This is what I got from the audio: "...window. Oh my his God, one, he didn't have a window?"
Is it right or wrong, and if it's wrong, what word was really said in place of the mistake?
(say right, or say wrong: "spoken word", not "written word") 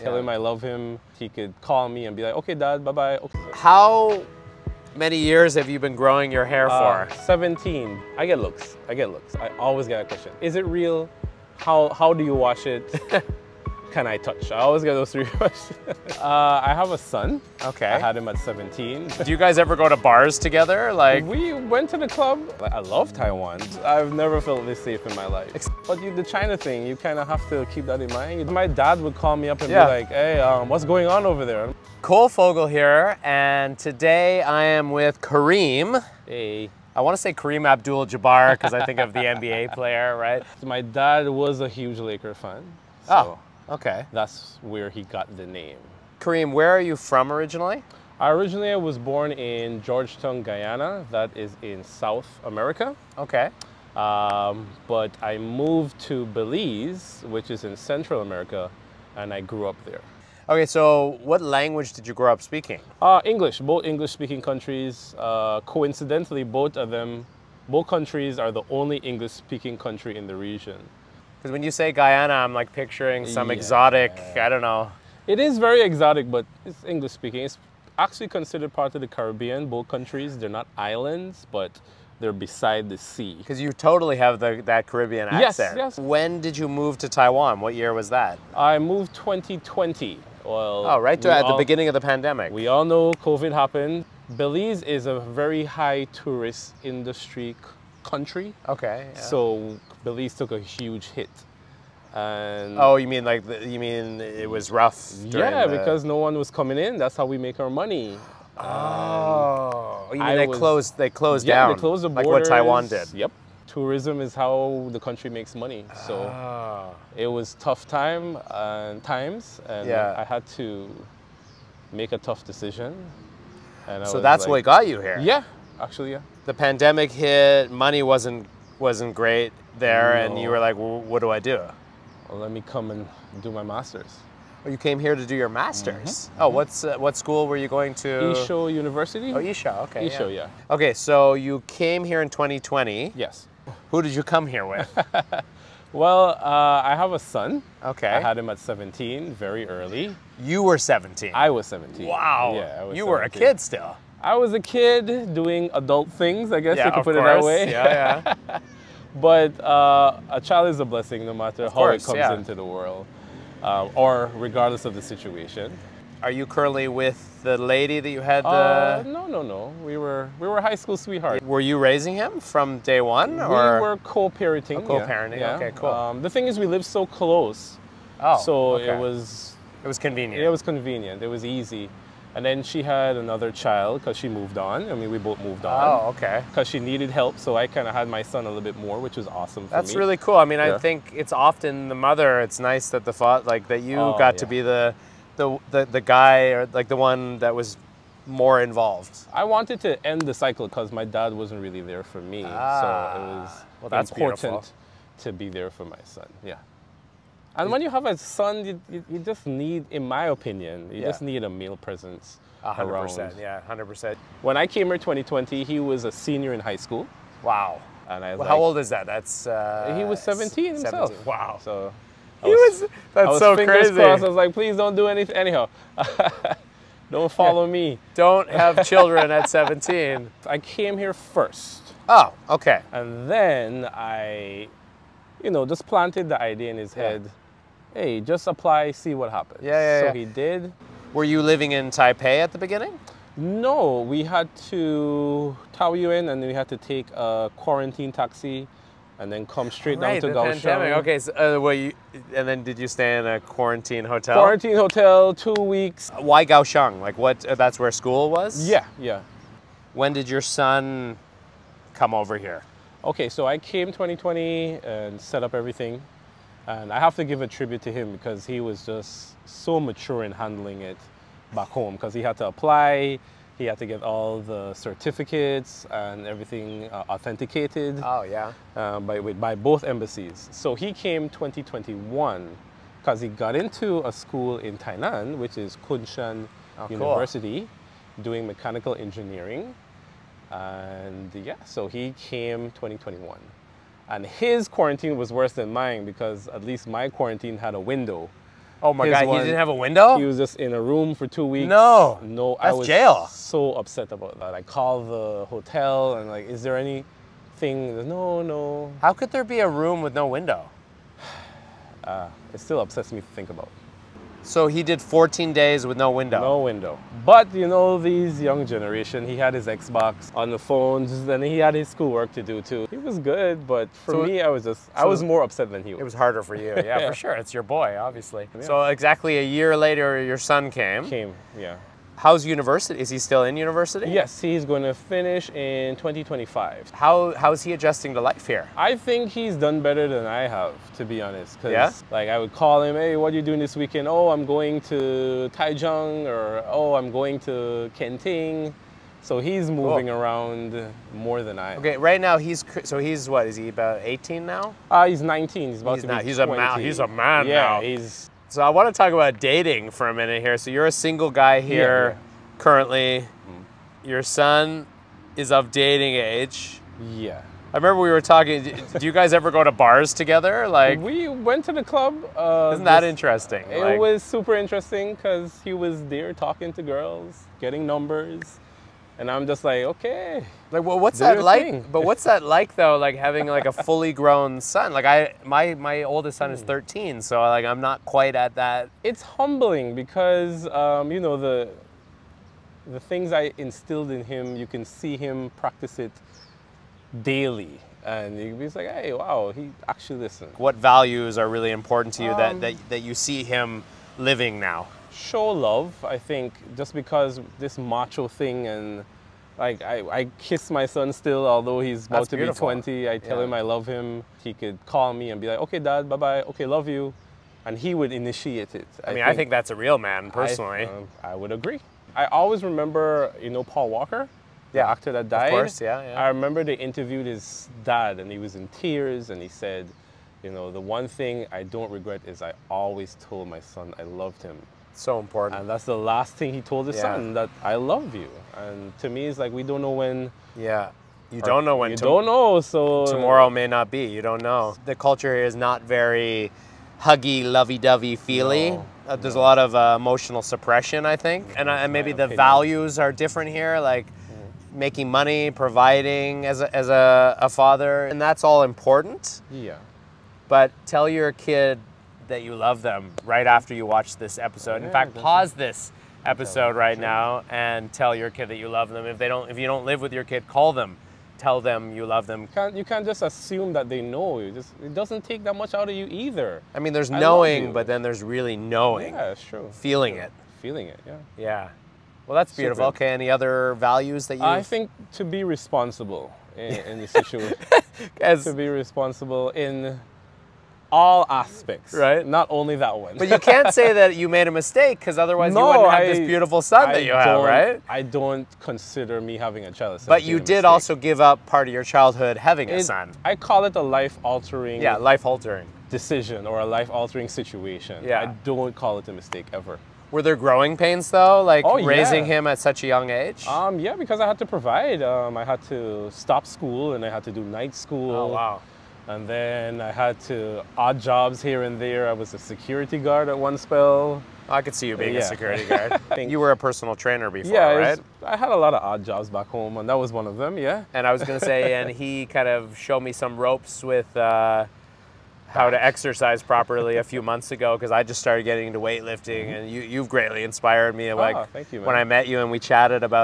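right.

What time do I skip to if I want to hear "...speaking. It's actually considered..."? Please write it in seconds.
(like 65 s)
77 s.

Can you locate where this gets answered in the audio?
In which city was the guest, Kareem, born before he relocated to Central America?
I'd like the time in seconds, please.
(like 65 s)
49 s.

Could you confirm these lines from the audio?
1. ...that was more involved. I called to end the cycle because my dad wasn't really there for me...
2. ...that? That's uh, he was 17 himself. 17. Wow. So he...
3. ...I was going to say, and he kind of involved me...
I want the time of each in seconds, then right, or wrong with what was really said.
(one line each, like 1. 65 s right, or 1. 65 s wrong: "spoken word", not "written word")
1. 197 s wrong: "wanted", not "called"
2. 218 s right
3. 531 s wrong: "showed", not "involved".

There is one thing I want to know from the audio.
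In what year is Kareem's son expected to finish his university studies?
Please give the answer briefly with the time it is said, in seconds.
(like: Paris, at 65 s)
2025, at 335 s.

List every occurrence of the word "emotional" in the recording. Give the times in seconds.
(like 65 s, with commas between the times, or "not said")
449 s.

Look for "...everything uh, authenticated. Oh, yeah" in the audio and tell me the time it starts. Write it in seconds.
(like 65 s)
276 s.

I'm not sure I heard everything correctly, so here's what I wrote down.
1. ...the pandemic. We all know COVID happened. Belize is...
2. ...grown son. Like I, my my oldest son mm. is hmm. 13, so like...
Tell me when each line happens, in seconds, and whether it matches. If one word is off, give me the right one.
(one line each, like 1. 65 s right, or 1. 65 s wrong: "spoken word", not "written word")
1. 91 s right
2. 384 s right.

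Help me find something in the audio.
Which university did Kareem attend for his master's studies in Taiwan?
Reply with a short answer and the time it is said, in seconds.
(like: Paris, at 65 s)
I-Shou University, at 138 s.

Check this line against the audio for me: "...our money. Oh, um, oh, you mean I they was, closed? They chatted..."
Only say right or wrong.
wrong.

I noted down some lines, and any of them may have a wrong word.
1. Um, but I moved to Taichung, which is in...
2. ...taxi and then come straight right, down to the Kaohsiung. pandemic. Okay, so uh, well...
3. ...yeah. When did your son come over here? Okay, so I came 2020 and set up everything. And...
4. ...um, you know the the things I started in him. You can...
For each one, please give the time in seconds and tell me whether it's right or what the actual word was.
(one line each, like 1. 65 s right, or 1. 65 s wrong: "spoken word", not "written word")
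1. 53 s wrong: "Belize", not "Taichung"
2. 248 s right
3. 258 s right
4. 390 s wrong: "instilled", not "started".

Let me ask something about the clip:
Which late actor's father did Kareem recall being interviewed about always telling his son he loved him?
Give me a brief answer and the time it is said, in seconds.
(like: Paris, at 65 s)
Paul Walker, at 423 s.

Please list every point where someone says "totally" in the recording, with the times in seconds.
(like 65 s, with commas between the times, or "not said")
83 s.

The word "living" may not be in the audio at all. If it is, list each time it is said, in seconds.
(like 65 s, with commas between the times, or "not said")
241 s, 404 s.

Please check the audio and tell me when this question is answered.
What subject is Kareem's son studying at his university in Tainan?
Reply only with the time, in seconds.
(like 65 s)
288 s.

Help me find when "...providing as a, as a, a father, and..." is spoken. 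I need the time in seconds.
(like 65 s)
455 s.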